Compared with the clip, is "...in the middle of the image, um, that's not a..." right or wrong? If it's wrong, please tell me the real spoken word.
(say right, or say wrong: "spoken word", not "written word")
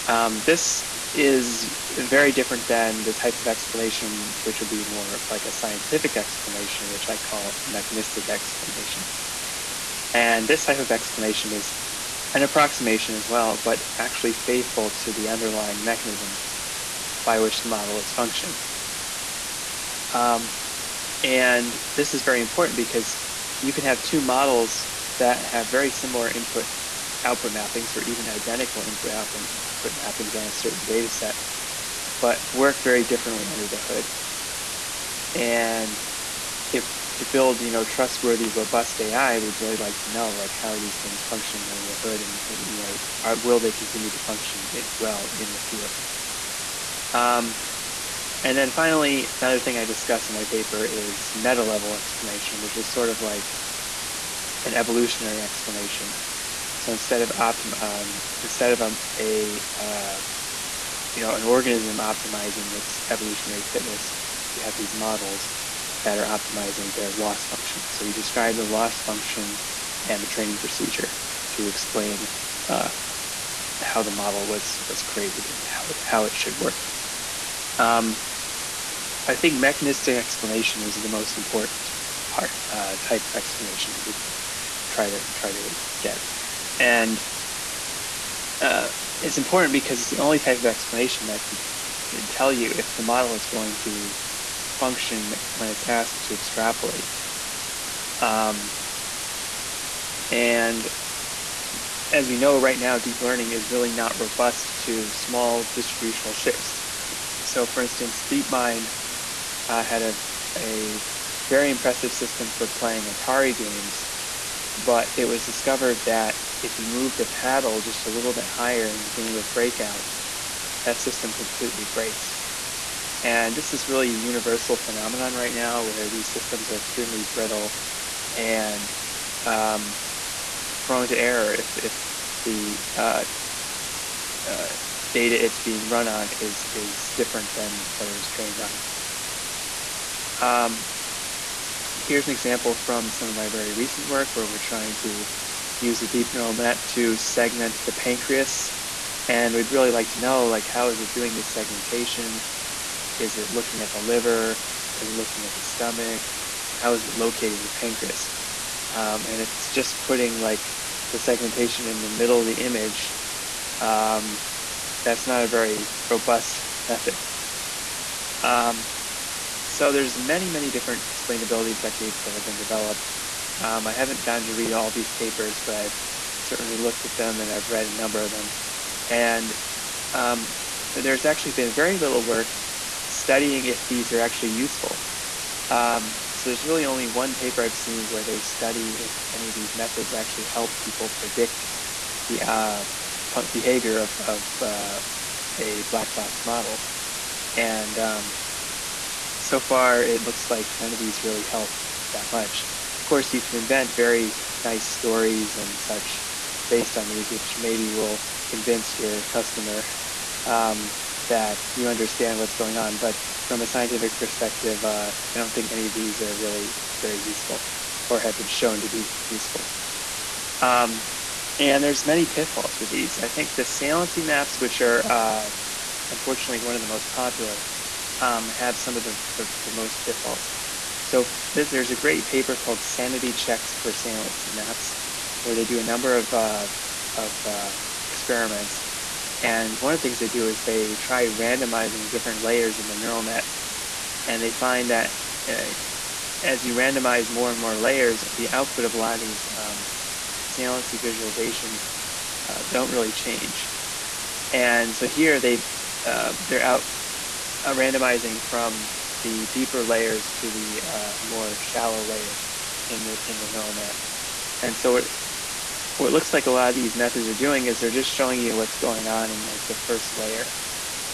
right.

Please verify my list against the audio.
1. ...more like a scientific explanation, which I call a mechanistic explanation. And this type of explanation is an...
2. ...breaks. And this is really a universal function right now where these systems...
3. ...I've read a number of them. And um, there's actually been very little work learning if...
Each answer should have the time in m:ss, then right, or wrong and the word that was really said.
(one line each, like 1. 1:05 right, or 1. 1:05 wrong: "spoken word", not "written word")
1. 0:04 right
2. 2:01 wrong: "phenomenon", not "function"
3. 2:57 wrong: "studying", not "learning".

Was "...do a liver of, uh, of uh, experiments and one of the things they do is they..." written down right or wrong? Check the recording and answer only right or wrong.
wrong.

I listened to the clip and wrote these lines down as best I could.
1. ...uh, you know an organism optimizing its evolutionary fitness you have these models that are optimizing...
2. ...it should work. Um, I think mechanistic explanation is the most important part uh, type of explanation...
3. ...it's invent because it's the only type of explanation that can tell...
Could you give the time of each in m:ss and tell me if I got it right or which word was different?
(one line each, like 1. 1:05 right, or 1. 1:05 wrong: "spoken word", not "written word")
1. 0:59 right
2. 1:16 right
3. 1:29 wrong: "important", not "invent".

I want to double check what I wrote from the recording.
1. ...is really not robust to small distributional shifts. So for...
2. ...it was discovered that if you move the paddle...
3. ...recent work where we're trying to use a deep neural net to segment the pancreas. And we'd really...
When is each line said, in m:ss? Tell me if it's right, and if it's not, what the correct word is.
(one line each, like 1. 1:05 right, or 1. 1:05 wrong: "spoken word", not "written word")
1. 1:43 right
2. 1:55 right
3. 2:23 right.